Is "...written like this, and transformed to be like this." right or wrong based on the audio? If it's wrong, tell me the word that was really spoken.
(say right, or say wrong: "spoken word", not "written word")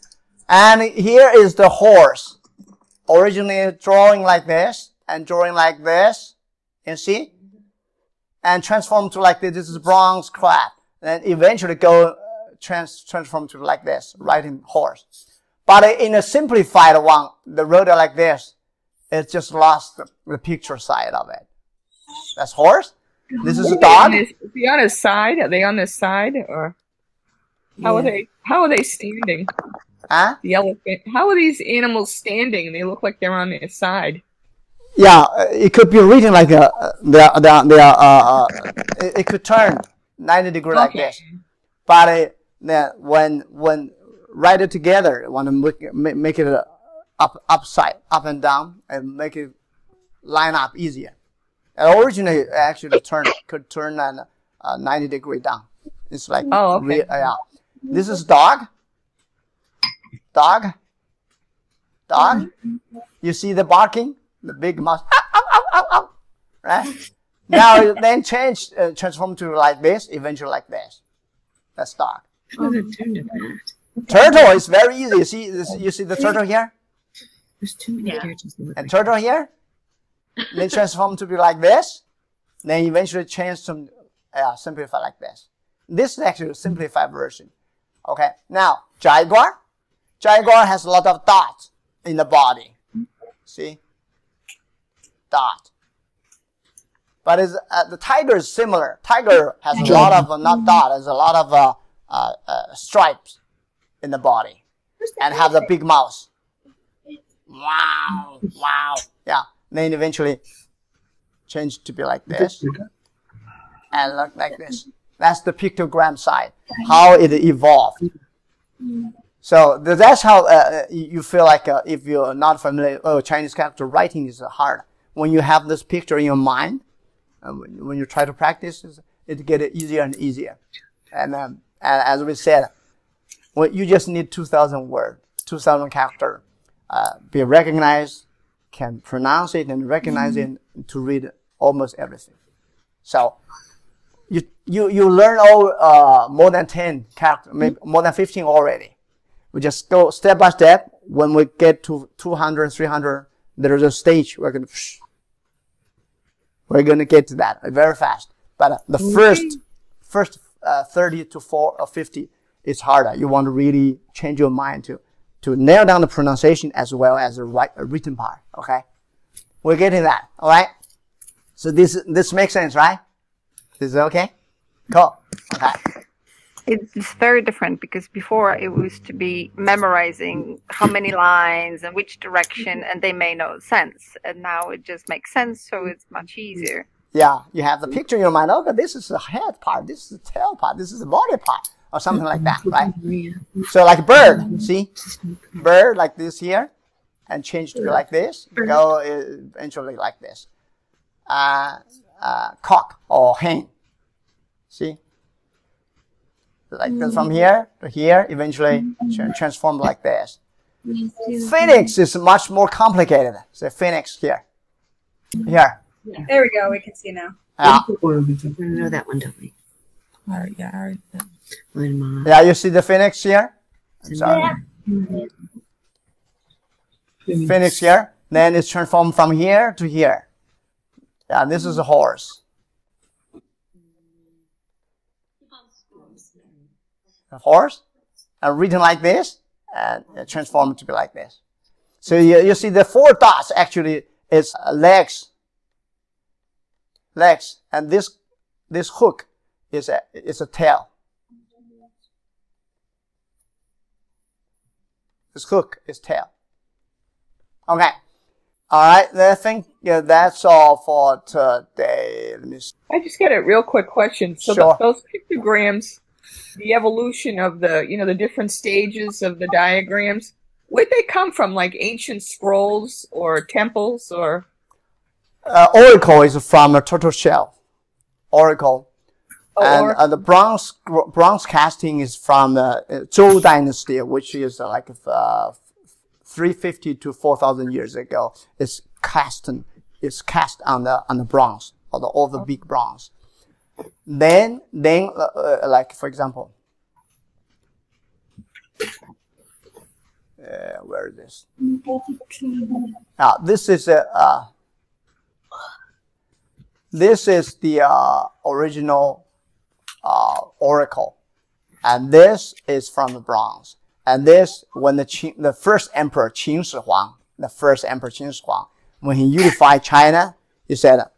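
right.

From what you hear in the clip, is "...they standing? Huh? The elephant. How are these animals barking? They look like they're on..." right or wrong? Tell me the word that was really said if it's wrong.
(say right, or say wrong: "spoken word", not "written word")
wrong: "standing", not "barking".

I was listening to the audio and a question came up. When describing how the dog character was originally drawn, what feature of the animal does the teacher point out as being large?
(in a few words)
big mouth.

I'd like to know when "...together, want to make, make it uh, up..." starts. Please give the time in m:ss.
0:44.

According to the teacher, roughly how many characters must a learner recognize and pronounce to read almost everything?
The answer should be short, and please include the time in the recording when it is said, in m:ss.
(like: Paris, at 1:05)
2,000, at 2:15.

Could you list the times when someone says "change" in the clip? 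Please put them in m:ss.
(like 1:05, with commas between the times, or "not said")
1:08, 1:23, 1:51, 2:44, 3:17.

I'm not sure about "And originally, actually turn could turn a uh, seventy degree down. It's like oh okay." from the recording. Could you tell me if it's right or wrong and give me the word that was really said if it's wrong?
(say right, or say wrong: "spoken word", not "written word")
wrong: "ninety", not "seventy".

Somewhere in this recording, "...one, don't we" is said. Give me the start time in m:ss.
3:39.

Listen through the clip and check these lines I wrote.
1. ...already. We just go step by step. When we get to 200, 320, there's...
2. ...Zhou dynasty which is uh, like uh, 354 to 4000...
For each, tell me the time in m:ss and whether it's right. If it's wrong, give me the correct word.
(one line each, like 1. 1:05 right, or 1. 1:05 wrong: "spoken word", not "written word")
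1. 2:28 wrong: "300", not "320"
2. 4:43 wrong: "350", not "354".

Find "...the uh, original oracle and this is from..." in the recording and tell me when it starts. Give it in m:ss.
5:07.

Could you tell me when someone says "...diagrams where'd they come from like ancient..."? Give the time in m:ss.
4:29.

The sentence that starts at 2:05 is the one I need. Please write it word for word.
When you have this picture in your mind, um, when you try to practice, it gets easier and easier.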